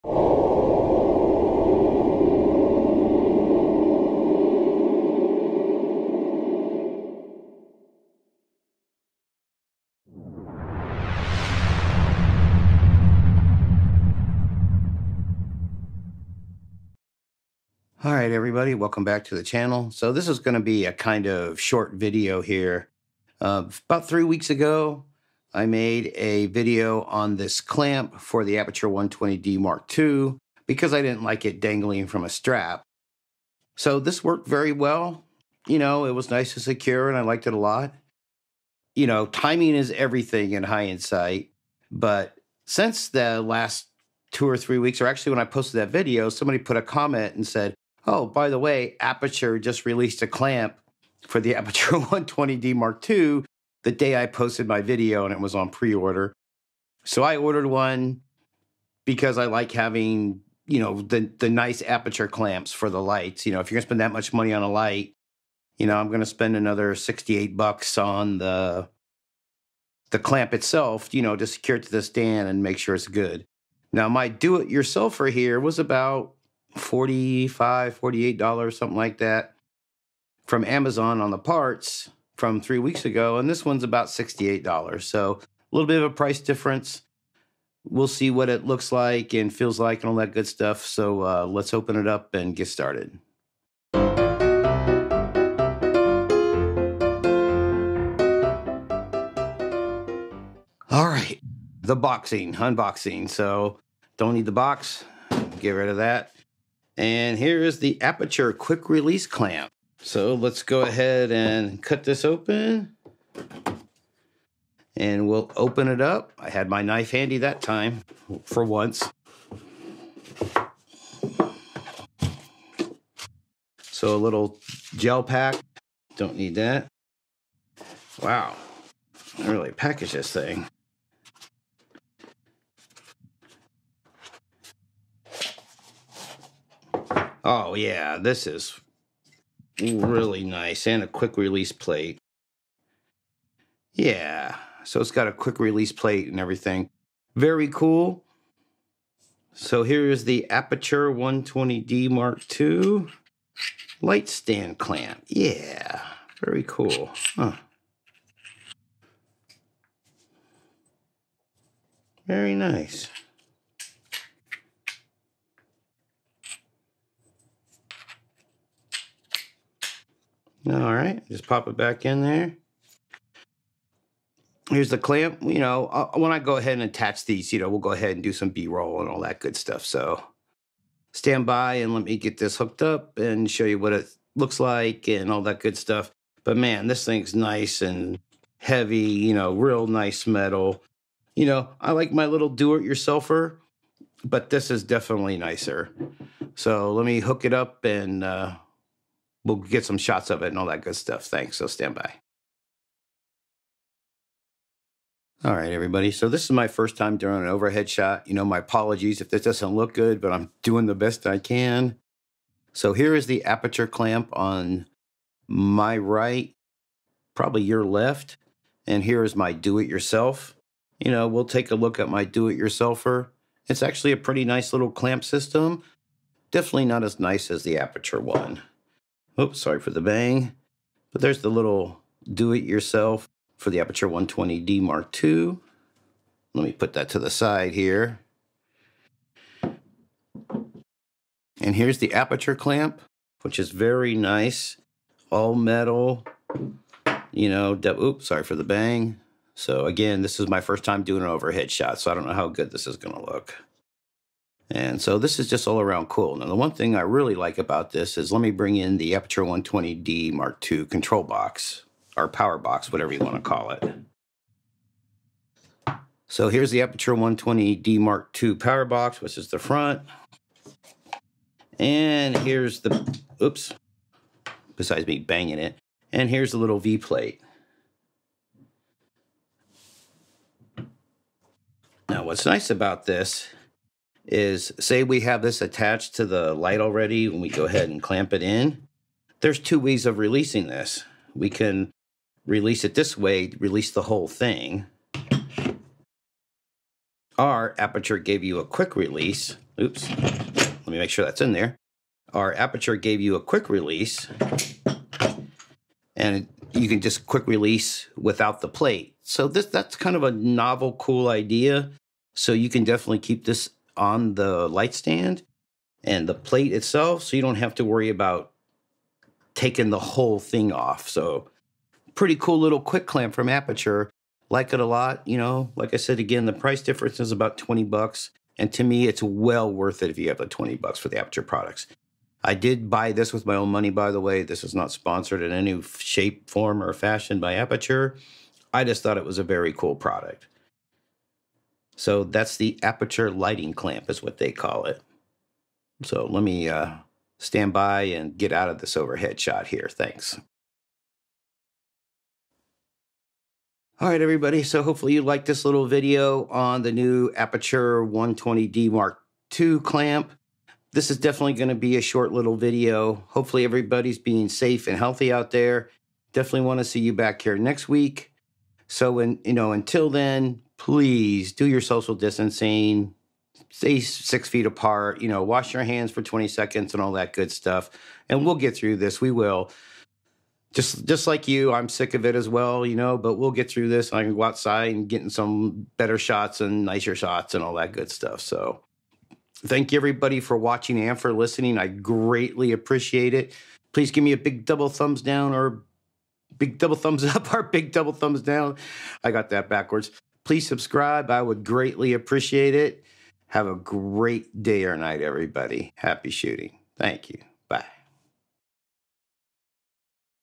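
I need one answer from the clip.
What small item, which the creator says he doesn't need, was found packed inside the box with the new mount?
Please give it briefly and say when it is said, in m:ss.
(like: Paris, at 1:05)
gel pack, at 2:04.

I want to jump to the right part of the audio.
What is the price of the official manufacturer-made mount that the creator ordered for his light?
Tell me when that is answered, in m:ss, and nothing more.
1:06.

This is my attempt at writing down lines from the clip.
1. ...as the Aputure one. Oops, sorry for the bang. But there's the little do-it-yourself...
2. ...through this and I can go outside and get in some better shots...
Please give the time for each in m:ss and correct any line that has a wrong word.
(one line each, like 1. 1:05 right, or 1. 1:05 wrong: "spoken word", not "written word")
1. 3:47 right
2. 6:23 right.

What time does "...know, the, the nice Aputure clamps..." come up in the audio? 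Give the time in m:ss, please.
1:00.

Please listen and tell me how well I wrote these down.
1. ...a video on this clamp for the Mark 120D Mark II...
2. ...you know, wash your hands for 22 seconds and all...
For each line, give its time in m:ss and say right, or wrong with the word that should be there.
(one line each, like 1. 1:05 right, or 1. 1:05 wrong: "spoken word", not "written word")
1. 0:26 wrong: "Aputure", not "Mark"
2. 6:15 wrong: "20", not "22".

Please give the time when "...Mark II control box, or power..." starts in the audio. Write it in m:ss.
4:20.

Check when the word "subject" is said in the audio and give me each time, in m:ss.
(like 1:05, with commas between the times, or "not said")
not said.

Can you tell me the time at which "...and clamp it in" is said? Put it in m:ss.
4:47.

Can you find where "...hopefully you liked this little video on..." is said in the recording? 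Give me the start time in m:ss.
5:54.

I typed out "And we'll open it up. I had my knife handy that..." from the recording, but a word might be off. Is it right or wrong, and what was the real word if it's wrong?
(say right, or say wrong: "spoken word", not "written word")
right.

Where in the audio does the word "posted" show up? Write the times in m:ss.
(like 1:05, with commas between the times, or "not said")
0:45, 0:54.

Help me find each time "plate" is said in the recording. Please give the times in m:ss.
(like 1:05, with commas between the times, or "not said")
2:21, 2:25, 4:36, 5:08, 5:16.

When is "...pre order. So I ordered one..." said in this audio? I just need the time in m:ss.
0:55.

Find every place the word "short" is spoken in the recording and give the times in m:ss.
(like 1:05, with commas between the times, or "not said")
0:21, 6:02.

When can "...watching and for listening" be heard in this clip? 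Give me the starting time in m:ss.
6:30.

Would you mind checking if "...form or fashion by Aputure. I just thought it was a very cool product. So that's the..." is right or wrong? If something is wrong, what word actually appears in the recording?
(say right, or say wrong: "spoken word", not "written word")
right.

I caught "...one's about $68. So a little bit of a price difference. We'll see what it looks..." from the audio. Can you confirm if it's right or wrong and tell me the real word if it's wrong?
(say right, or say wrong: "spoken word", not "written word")
right.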